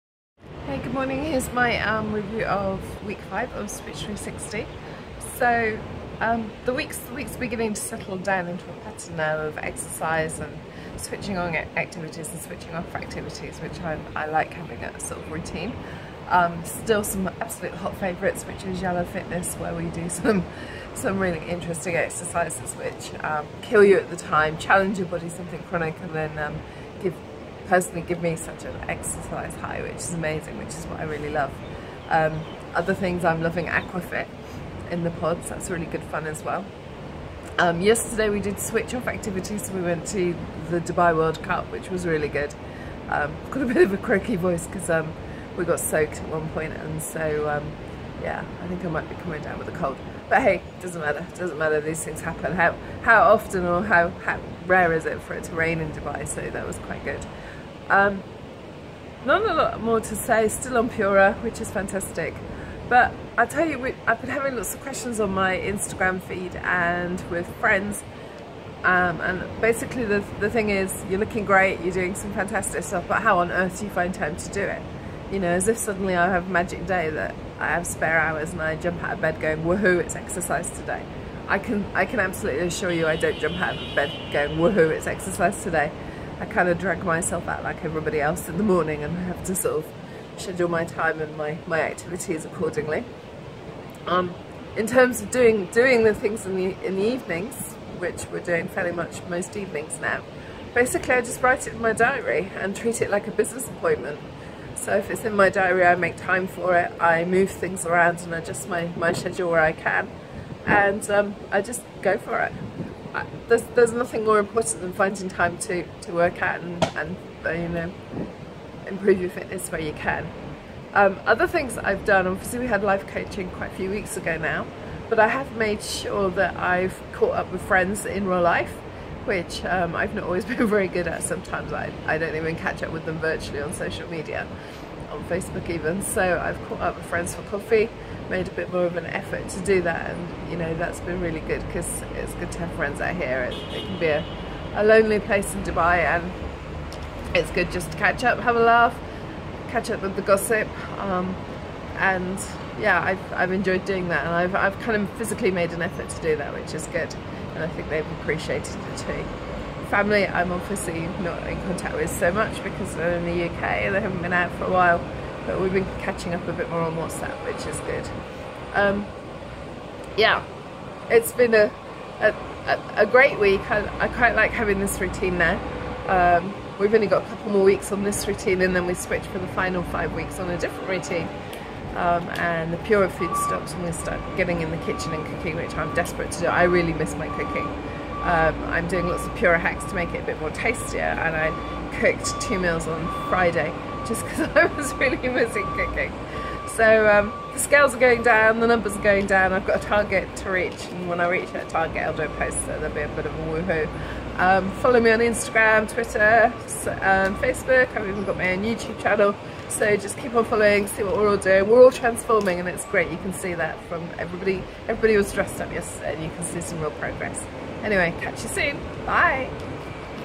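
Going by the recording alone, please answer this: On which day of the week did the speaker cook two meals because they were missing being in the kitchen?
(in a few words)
Friday.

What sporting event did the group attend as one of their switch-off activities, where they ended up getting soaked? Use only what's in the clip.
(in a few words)
Dubai World Cup.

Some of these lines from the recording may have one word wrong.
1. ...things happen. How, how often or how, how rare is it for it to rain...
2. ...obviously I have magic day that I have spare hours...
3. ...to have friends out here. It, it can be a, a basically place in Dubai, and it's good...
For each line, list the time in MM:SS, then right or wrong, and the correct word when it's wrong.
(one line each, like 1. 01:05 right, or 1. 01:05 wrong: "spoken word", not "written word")
1. 00:52 right
2. 01:15 wrong: "suddenly", not "obviously"
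3. 02:22 wrong: "lonely", not "basically".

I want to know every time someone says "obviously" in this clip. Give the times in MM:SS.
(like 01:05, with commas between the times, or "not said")
02:02, 02:40.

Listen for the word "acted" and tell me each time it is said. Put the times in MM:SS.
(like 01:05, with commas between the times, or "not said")
not said.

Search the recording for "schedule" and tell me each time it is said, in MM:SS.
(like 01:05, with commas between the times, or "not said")
01:30, 01:49.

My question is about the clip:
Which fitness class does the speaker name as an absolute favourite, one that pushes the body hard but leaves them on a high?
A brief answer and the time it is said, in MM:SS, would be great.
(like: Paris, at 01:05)
Yellow Fitness, at 00:18.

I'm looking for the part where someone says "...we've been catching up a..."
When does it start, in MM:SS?
02:45.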